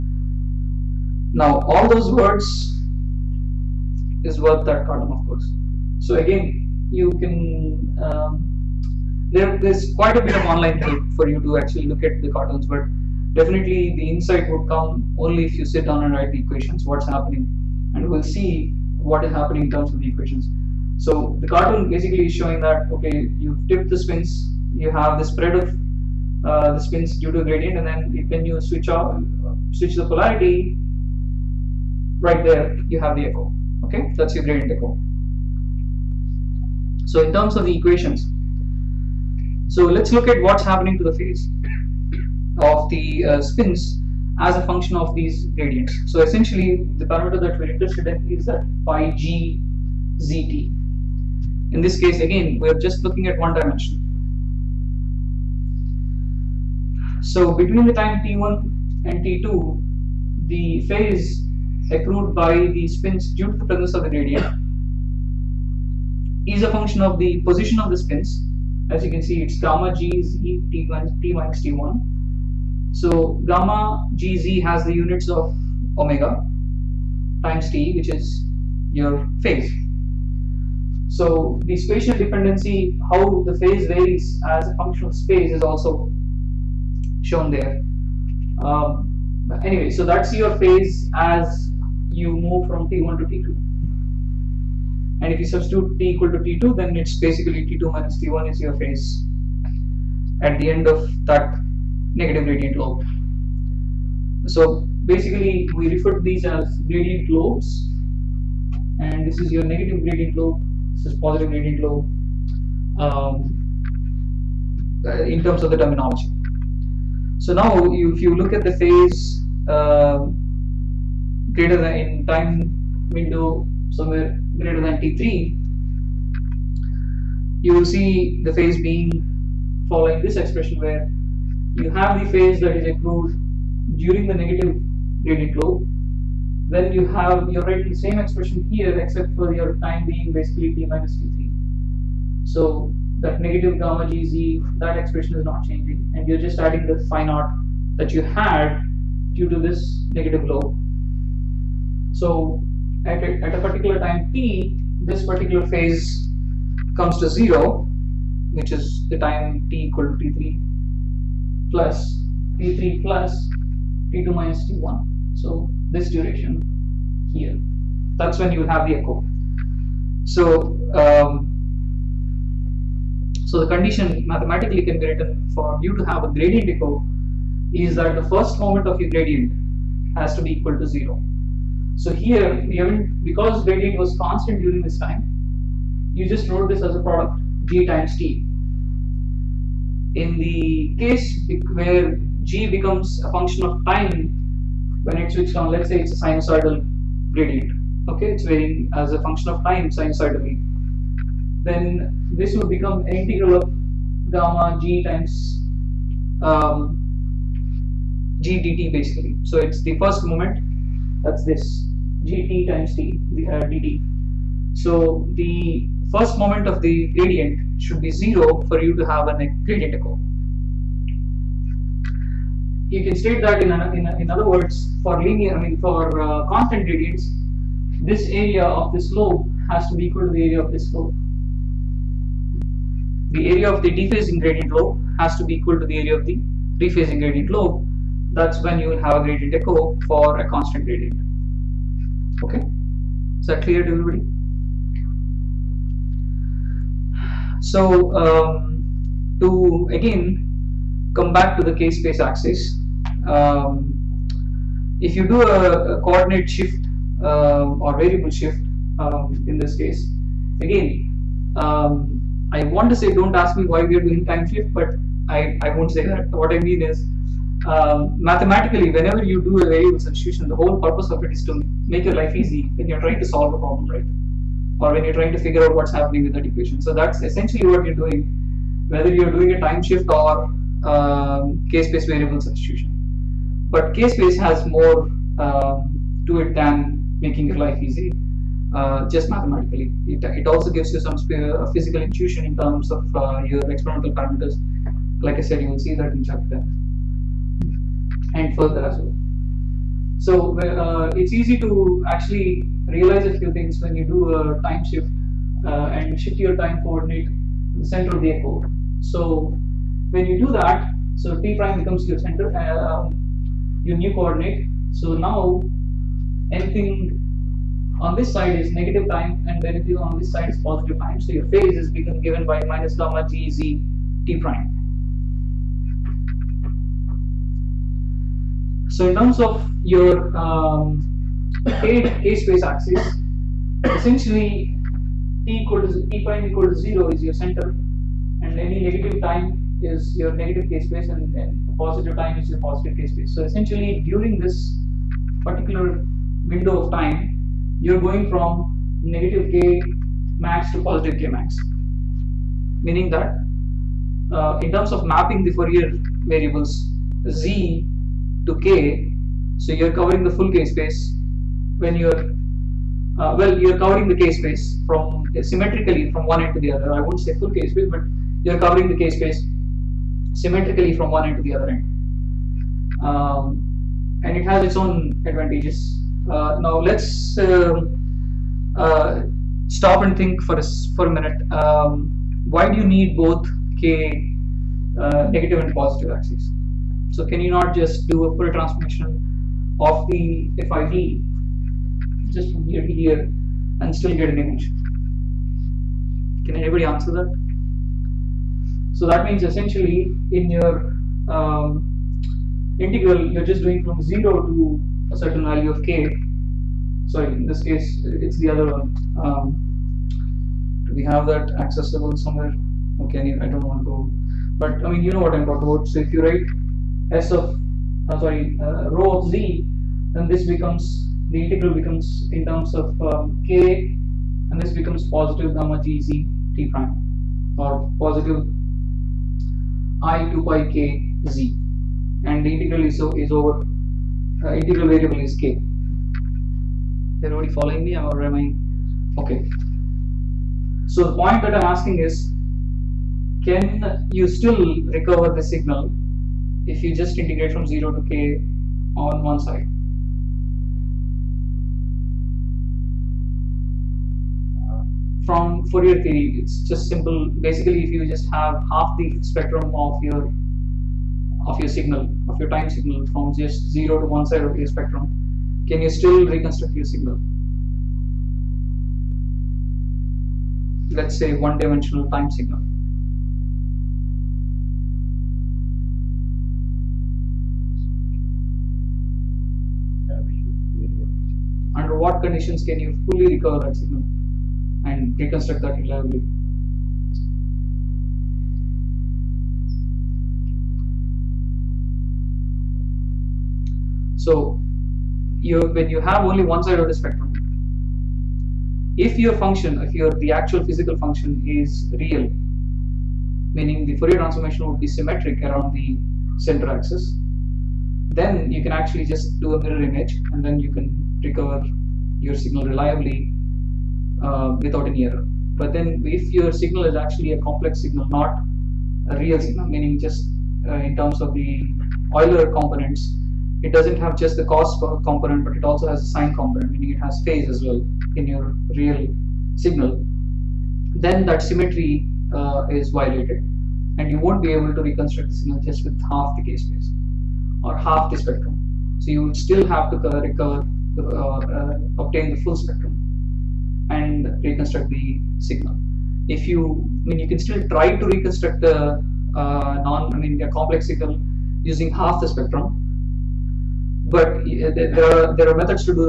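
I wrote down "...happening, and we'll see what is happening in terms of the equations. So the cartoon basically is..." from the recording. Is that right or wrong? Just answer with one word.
right.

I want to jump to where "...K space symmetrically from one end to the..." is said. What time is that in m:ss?
6:08.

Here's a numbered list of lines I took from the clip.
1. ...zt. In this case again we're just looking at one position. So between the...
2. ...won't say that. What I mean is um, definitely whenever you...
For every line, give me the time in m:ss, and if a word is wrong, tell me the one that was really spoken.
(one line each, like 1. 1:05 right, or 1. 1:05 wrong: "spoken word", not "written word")
1. 0:50 wrong: "dimension", not "position"
2. 4:25 wrong: "mathematically", not "definitely".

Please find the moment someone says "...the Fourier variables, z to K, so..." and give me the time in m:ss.
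5:55.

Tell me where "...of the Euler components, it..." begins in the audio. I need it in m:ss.
8:41.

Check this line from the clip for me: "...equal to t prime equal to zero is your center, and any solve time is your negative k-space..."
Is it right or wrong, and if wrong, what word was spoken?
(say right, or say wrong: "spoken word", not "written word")
wrong: "negative", not "solve".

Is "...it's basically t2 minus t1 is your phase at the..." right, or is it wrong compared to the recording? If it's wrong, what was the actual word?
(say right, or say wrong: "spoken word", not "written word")
right.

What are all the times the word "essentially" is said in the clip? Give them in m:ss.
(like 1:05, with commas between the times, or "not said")
0:46, 4:37, 5:33, 5:43, 6:39.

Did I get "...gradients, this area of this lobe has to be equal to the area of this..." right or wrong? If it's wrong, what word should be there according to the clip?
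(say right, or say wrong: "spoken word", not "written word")
right.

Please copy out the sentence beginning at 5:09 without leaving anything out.
So when you do that, so t prime becomes your center, um, your new coordinate.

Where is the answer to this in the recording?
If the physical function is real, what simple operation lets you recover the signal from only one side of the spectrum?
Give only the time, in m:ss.
8:29.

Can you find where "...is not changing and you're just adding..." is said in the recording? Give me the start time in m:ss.
2:25.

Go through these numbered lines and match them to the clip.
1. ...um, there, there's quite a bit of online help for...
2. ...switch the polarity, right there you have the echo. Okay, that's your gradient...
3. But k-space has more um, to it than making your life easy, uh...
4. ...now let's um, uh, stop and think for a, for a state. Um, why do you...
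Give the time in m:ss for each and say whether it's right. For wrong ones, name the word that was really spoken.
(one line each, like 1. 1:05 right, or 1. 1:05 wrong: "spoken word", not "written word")
1. 0:07 right
2. 0:29 right
3. 4:43 right
4. 6:16 wrong: "minute", not "state".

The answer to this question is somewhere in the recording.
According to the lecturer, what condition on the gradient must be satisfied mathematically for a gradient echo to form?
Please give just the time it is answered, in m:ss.
2:58.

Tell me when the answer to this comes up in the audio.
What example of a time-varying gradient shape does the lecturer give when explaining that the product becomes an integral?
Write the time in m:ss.
3:16.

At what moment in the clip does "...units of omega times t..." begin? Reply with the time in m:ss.
1:14.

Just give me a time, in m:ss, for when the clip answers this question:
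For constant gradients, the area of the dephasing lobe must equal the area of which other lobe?
3:56.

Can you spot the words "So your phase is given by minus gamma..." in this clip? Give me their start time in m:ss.
5:21.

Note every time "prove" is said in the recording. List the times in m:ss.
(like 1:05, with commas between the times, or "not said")
not said.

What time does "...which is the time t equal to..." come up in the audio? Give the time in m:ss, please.
2:38.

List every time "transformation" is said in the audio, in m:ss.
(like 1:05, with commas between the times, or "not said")
6:28, 8:24.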